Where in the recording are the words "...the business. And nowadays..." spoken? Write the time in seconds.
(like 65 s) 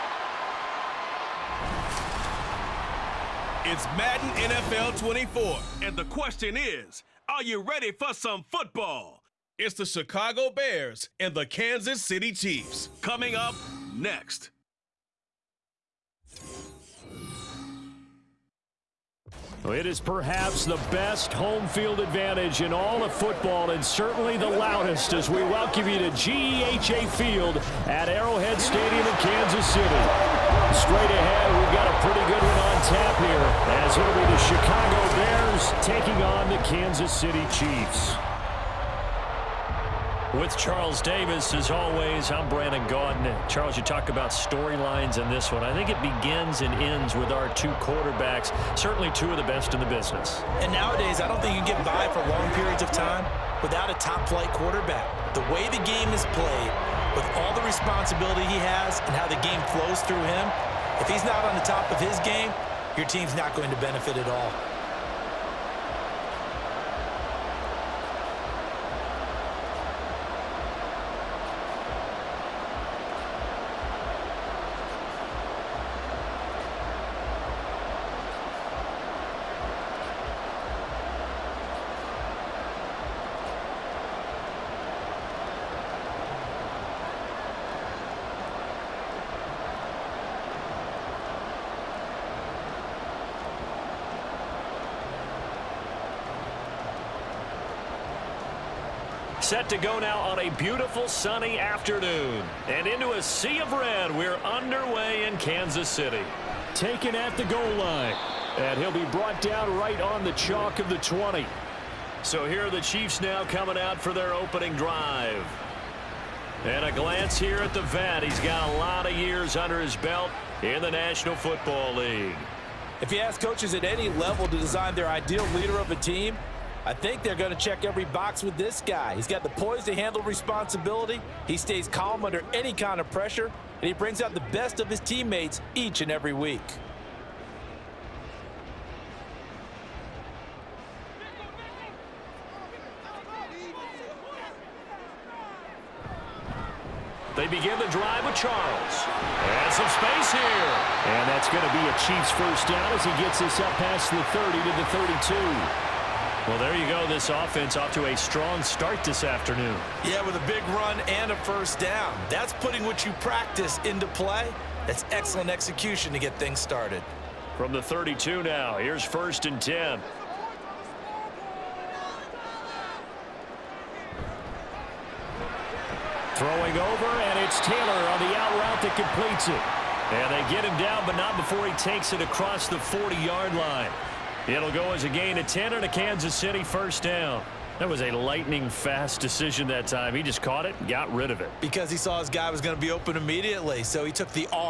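49 s.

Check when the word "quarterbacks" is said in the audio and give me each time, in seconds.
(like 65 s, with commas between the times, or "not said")
47 s, 54 s.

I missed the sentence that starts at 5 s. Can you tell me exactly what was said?
And the question is, are you ready for some football?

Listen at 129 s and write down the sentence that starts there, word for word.
He's got the poise to handle responsibility.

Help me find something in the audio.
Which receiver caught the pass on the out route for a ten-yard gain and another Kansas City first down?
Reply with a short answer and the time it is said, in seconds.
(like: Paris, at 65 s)
Taylor, at 177 s.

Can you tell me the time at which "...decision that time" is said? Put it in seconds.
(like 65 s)
189 s.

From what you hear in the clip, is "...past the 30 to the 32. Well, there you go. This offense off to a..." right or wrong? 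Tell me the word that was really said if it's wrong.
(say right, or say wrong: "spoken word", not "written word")
right.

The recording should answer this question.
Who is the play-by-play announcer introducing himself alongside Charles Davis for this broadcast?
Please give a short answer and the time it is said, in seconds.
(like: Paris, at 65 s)
Brandon Gaudin, at 42 s.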